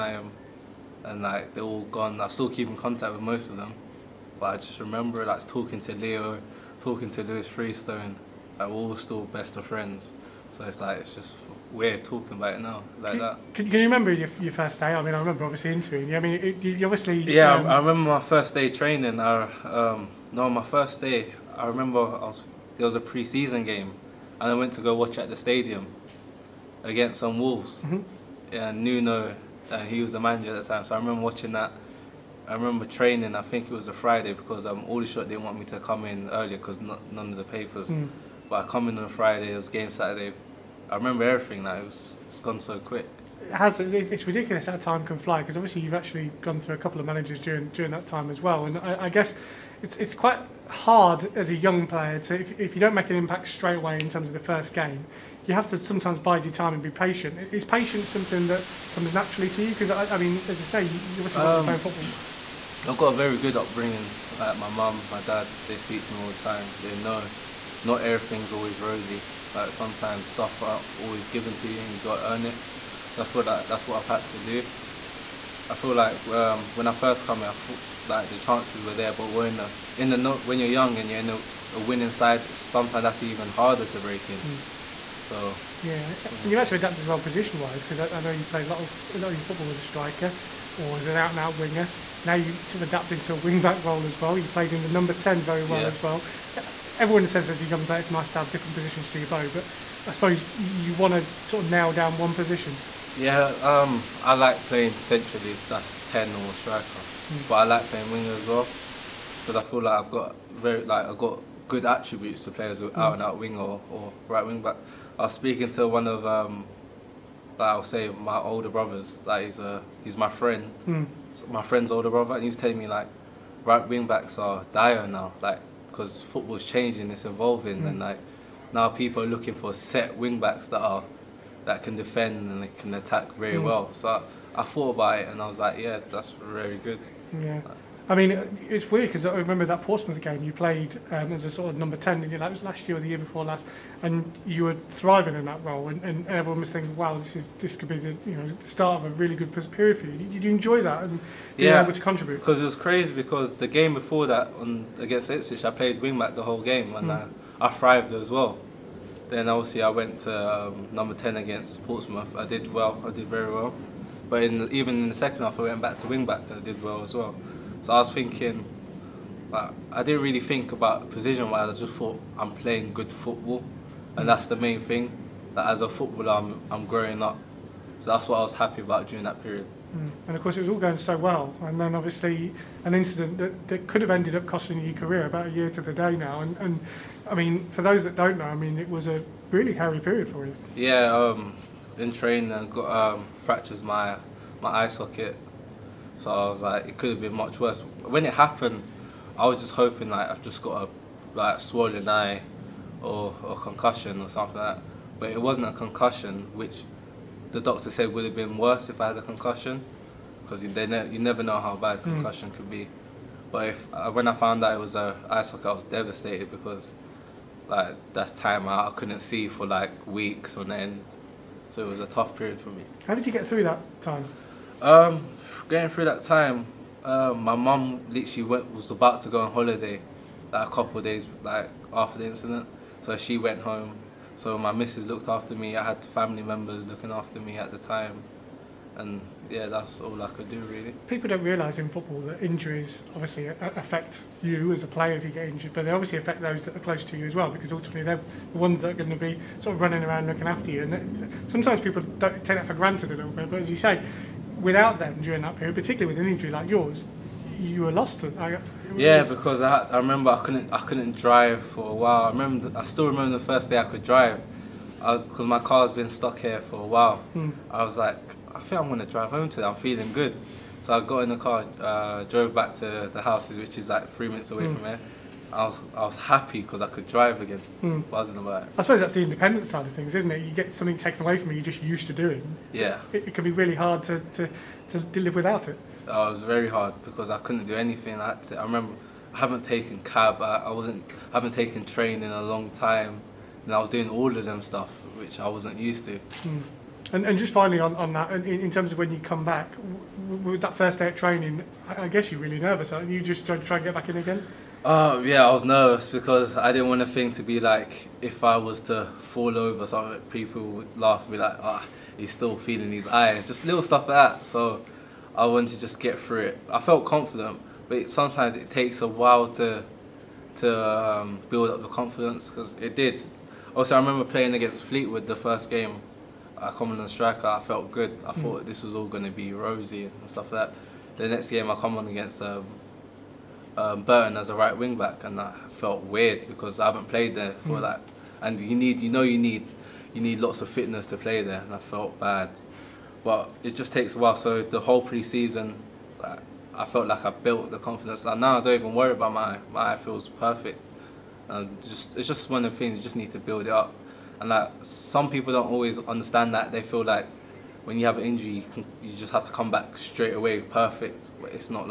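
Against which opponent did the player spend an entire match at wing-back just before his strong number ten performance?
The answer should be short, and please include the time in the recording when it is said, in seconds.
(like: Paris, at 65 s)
Ipswich, at 155 s.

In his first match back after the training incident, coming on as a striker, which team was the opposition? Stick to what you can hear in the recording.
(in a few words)
Fleetwood.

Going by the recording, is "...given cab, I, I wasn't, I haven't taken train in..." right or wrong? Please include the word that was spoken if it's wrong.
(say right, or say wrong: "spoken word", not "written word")
wrong: "taken", not "given".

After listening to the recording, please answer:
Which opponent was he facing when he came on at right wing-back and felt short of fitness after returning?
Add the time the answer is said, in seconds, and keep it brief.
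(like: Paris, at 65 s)
Burton, at 334 s.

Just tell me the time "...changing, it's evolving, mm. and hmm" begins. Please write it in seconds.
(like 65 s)
126 s.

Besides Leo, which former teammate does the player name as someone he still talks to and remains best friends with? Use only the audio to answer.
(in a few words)
Lewis Freestone.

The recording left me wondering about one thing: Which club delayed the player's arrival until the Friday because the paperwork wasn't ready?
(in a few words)
Aldershot.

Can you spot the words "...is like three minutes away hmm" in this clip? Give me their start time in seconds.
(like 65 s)
273 s.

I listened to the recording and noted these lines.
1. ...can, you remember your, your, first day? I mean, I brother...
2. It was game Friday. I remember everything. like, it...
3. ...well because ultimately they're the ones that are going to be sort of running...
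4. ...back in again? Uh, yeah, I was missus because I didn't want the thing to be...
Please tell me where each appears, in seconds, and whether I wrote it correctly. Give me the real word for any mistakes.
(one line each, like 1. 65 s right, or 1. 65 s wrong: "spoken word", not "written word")
1. 13 s wrong: "remember", not "brother"
2. 39 s wrong: "Saturday", not "Friday"
3. 247 s right
4. 303 s wrong: "nervous", not "missus".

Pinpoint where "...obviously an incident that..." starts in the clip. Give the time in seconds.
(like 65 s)
181 s.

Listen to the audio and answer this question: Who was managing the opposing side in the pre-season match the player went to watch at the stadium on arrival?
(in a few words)
Nuno.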